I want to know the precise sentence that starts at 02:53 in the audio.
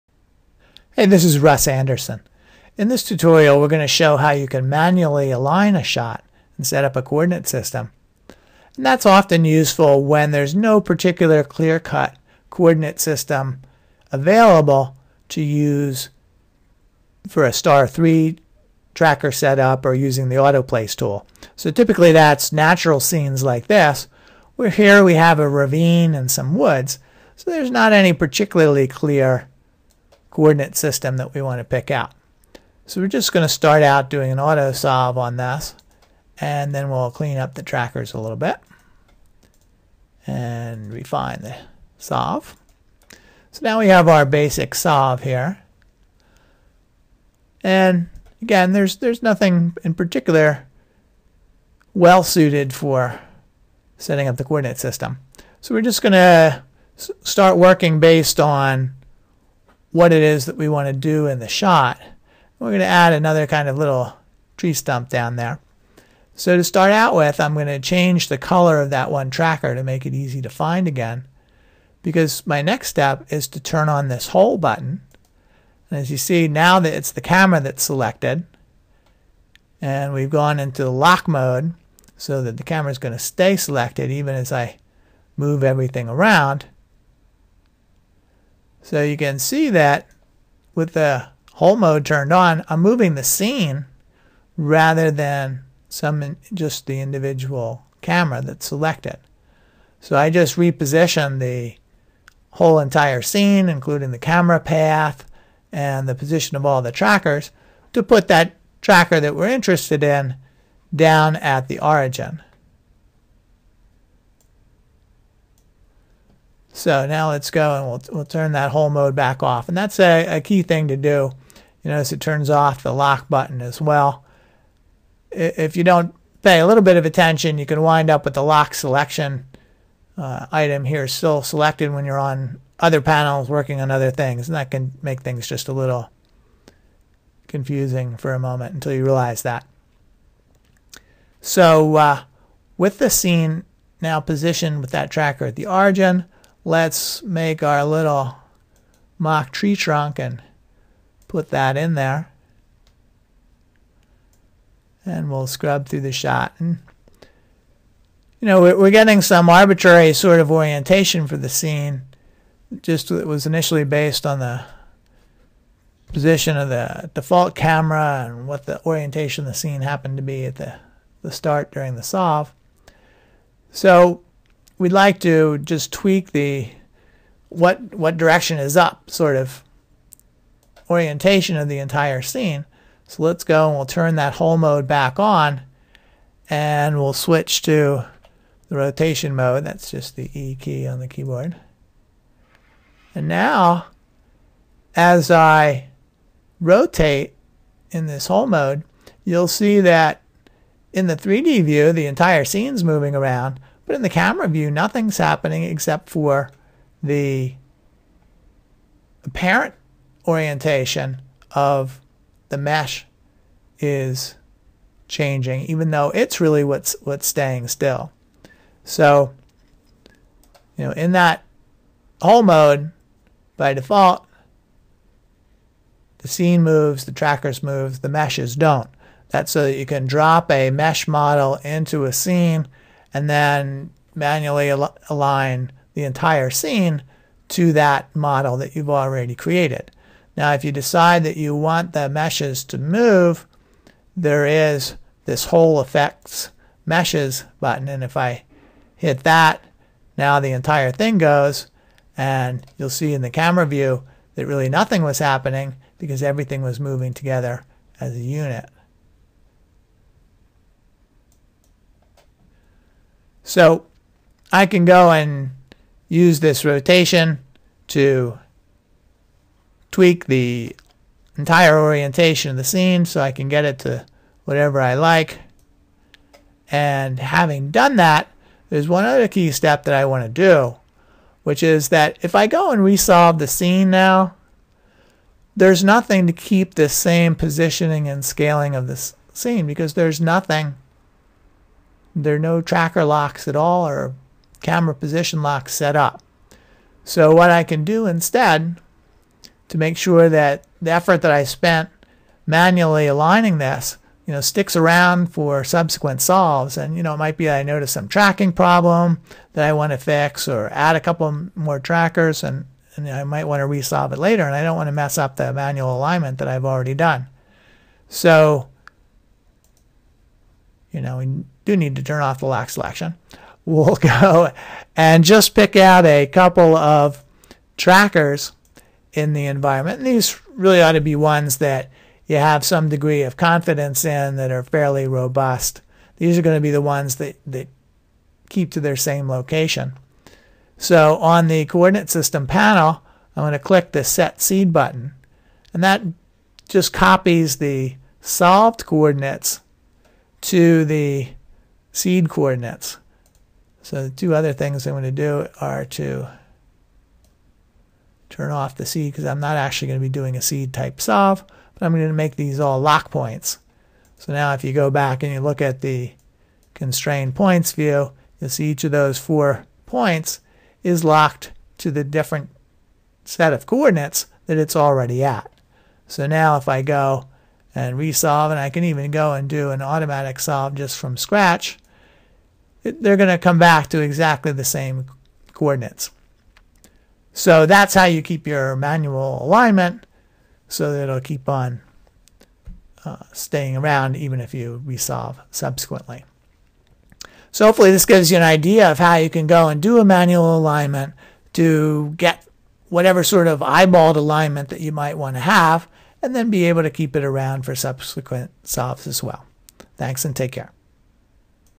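So we'd like to just tweak the what what direction is up sort of orientation of the entire scene.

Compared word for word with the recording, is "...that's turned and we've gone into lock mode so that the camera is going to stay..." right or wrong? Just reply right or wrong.
wrong.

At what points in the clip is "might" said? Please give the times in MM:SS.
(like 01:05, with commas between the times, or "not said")
05:07, 05:13, 06:44.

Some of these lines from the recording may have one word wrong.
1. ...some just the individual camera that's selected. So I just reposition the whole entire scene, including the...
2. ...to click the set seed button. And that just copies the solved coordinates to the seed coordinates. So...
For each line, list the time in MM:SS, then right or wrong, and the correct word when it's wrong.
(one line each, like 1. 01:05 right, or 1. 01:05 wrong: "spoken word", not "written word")
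1. 01:35 right
2. 05:43 right.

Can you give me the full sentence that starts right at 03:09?
That's just the E key on the keyboard.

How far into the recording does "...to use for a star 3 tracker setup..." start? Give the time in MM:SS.
00:15.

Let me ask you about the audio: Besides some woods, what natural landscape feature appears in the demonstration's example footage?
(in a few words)
A ravine.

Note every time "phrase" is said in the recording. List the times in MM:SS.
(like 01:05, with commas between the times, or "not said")
not said.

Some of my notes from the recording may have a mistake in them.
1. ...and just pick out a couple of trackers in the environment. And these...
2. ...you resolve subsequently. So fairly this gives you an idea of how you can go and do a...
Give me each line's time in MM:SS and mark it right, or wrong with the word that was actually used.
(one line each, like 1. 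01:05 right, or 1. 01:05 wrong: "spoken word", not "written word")
1. 05:24 right
2. 06:34 wrong: "hopefully", not "fairly".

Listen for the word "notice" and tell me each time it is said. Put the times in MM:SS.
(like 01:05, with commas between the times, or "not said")
02:01, 05:07.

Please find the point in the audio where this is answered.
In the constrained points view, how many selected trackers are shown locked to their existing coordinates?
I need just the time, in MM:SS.
06:09.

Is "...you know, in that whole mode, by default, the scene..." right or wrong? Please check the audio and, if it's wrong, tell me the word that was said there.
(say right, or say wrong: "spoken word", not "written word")
right.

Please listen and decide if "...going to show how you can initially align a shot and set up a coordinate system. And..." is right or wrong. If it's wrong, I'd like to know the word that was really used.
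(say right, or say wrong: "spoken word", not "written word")
wrong: "manually", not "initially".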